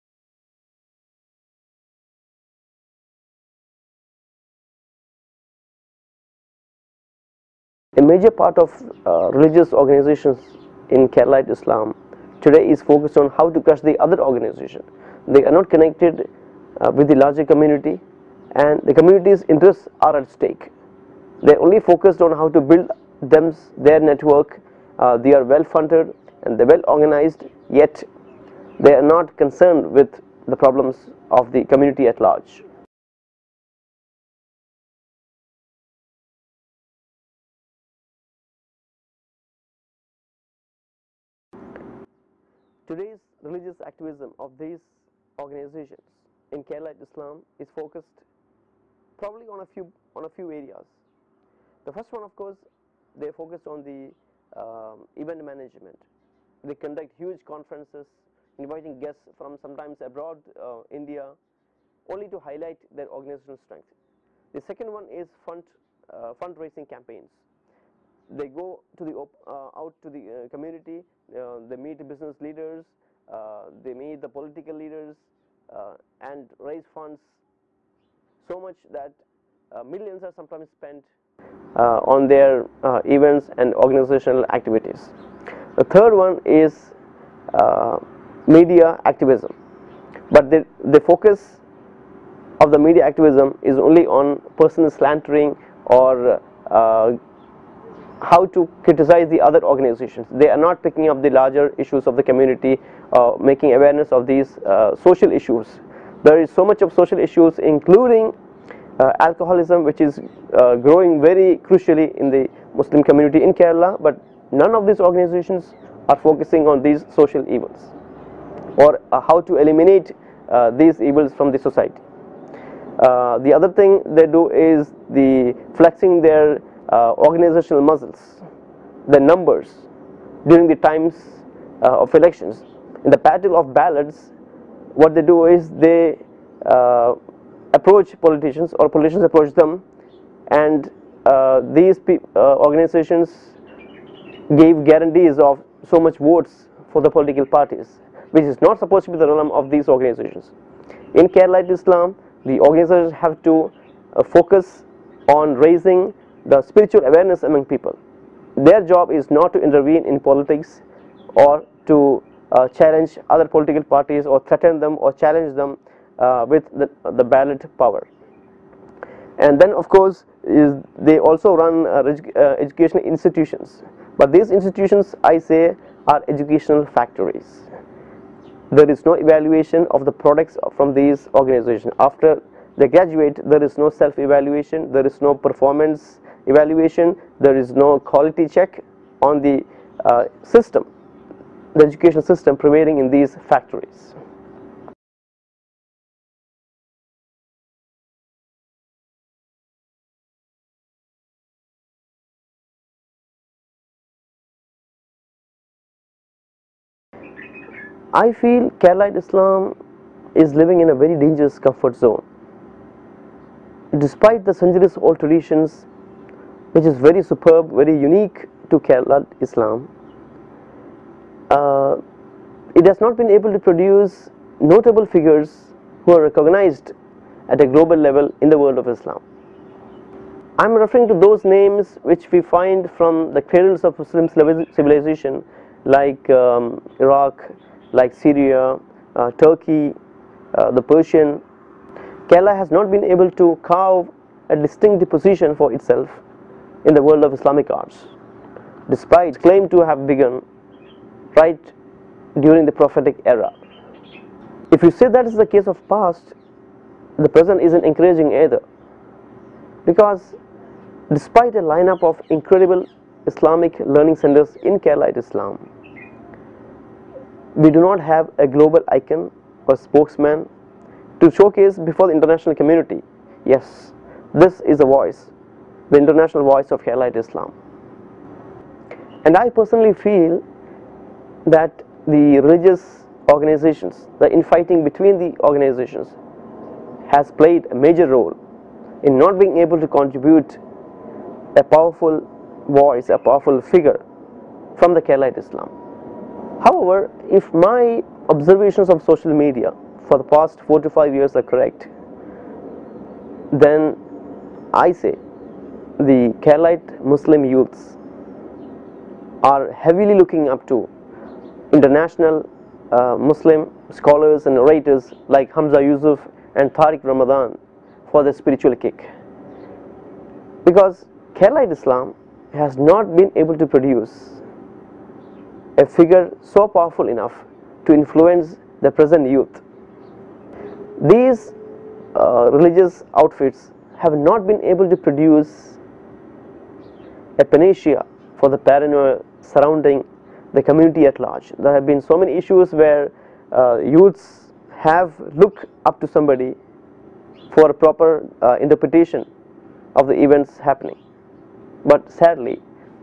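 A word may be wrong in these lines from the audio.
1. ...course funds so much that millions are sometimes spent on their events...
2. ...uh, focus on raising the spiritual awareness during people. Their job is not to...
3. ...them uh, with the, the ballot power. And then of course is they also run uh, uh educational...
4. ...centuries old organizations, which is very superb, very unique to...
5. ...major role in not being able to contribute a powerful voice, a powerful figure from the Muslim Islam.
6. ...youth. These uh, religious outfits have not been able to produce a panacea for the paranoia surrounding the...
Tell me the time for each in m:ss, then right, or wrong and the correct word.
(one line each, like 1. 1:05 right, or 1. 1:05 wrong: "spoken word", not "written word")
1. 1:16 wrong: "raise", not "course"
2. 2:34 wrong: "among", not "during"
3. 2:45 right
4. 3:34 wrong: "traditions", not "organizations"
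5. 4:47 wrong: "Keralite", not "Muslim"
6. 5:29 right.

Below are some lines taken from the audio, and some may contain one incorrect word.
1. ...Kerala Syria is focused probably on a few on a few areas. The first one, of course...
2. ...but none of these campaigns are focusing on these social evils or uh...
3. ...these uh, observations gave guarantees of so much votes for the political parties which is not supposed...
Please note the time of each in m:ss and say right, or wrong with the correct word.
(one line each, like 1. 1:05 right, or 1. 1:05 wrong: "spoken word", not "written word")
1. 0:46 wrong: "Islam", not "Syria"
2. 1:54 wrong: "organizations", not "campaigns"
3. 2:21 wrong: "organizations", not "observations".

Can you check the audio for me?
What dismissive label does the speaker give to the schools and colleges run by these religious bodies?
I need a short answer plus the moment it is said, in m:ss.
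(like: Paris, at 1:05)
Educational factories, at 2:56.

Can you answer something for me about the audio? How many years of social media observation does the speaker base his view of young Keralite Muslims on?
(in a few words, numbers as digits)
4 to 5.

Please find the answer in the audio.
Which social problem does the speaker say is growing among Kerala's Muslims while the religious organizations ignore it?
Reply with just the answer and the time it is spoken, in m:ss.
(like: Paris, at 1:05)
Alcoholism, at 1:49.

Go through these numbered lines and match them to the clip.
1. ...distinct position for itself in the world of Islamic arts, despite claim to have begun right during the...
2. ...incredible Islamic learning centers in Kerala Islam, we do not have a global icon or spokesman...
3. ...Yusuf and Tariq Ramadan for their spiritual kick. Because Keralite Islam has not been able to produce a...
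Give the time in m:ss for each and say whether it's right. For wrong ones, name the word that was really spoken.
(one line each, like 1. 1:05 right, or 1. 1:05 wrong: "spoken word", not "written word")
1. 4:04 right
2. 4:22 right
3. 5:15 right.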